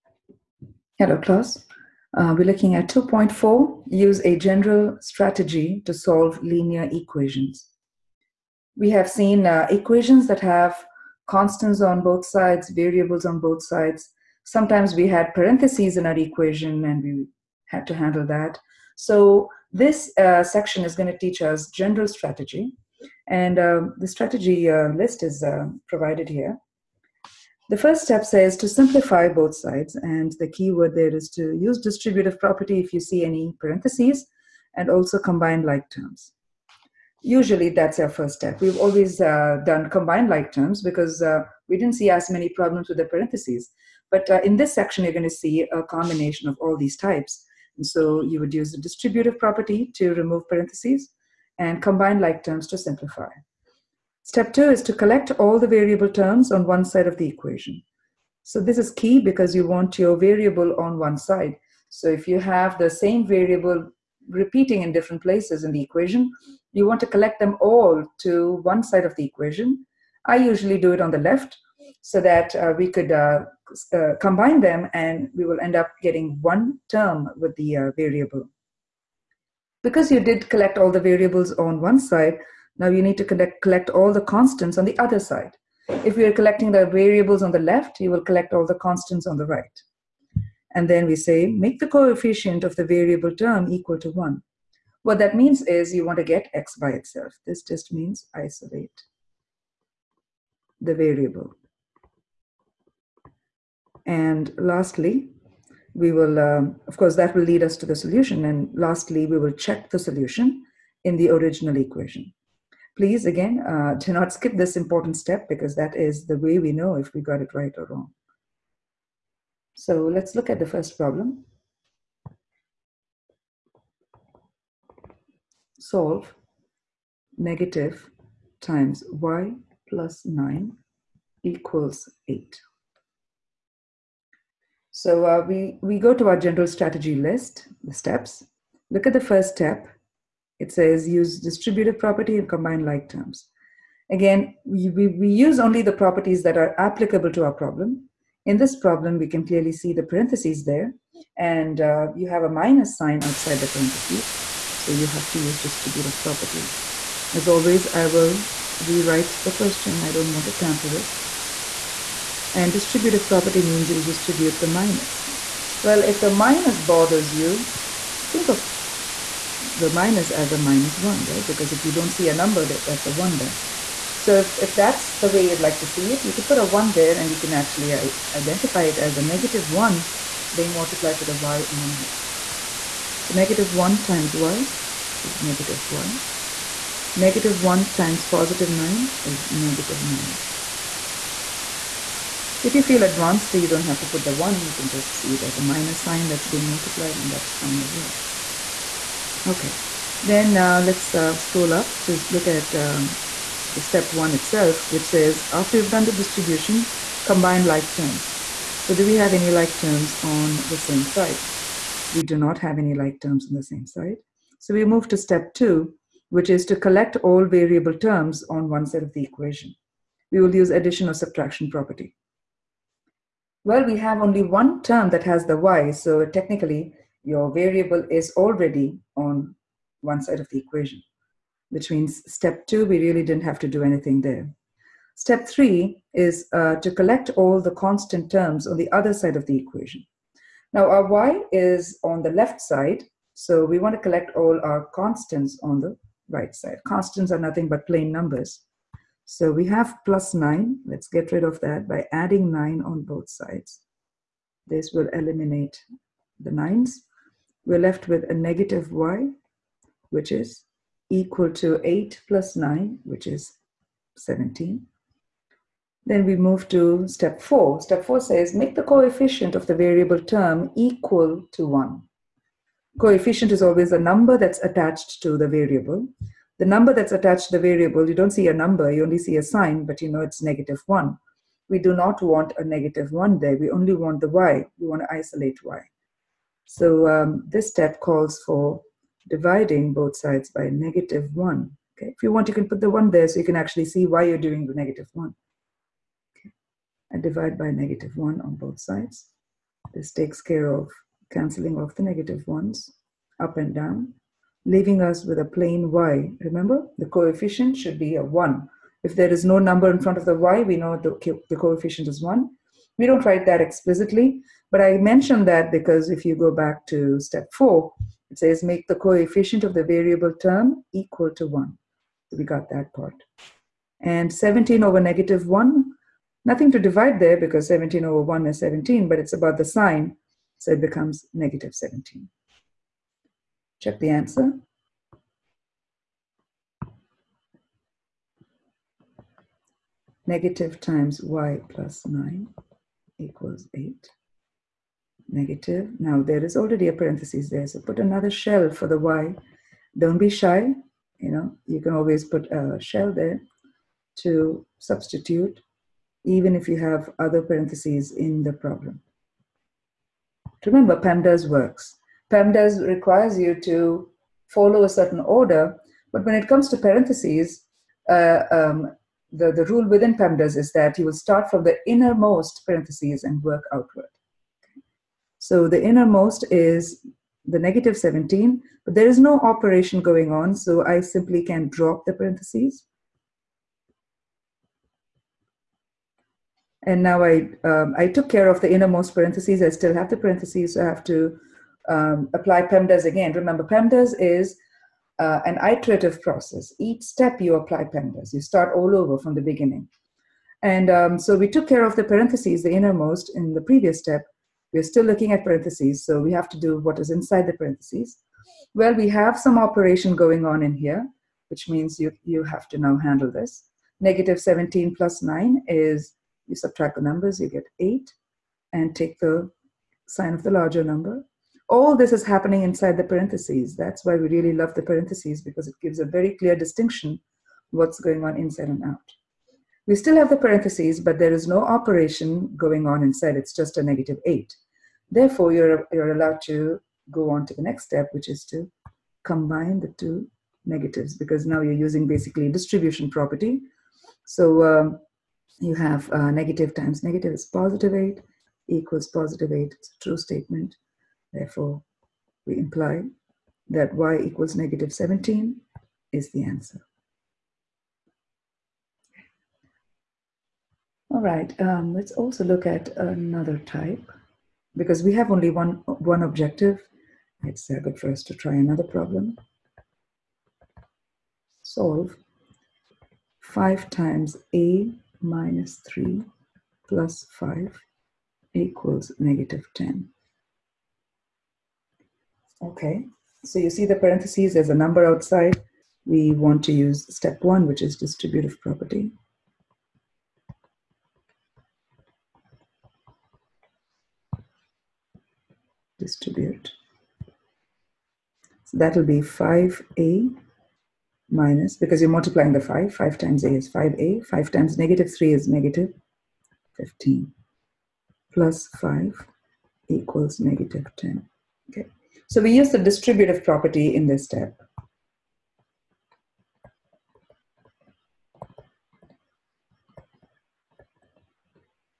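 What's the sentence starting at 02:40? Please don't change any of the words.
I don't want to tamper it.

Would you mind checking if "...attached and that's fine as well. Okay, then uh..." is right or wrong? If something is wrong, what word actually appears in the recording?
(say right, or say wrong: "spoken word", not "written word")
wrong: "multiplied", not "attached".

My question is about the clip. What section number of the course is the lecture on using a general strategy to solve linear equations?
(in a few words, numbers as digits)
2.4.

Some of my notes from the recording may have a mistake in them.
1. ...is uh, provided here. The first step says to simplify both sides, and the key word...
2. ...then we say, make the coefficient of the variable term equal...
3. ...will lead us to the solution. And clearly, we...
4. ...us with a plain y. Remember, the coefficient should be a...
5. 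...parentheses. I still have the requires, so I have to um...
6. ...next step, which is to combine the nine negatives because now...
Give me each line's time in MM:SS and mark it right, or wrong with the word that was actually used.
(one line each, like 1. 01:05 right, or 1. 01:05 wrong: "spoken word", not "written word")
1. 00:25 right
2. 01:30 right
3. 01:47 wrong: "lastly", not "clearly"
4. 05:05 right
5. 06:29 wrong: "parentheses", not "requires"
6. 07:17 wrong: "two", not "nine".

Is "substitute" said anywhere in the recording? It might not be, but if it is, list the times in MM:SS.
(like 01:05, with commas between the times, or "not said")
05:54.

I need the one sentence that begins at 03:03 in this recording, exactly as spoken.
So negative one times y is negative y.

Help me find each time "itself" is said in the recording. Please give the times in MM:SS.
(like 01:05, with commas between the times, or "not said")
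01:36, 03:24.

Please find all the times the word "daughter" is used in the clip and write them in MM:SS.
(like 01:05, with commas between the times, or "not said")
not said.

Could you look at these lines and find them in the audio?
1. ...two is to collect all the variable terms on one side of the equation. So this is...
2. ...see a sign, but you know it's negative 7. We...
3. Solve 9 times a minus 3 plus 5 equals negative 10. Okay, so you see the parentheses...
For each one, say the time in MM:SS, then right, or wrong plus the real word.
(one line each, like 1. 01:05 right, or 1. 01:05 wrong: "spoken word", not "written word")
1. 00:54 right
2. 04:39 wrong: "1", not "7"
3. 07:51 wrong: "5", not "9".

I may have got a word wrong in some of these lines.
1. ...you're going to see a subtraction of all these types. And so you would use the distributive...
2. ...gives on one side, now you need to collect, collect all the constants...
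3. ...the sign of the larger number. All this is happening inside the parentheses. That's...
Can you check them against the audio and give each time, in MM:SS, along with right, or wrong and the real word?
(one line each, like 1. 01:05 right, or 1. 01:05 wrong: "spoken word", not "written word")
1. 00:45 wrong: "combination", not "subtraction"
2. 01:20 wrong: "variables", not "gives"
3. 06:59 right.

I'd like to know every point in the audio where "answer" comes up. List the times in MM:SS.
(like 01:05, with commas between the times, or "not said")
05:34, 07:36.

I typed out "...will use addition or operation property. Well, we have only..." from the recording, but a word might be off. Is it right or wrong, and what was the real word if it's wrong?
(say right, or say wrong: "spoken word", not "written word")
wrong: "subtraction", not "operation".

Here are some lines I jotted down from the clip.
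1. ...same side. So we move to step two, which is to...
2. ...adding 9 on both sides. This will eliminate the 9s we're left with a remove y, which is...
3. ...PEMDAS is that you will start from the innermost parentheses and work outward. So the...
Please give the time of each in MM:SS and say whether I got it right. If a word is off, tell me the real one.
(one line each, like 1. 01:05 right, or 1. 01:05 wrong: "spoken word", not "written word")
1. 03:33 right
2. 04:12 wrong: "negative", not "remove"
3. 06:10 right.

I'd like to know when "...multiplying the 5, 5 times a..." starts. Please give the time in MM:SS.
08:22.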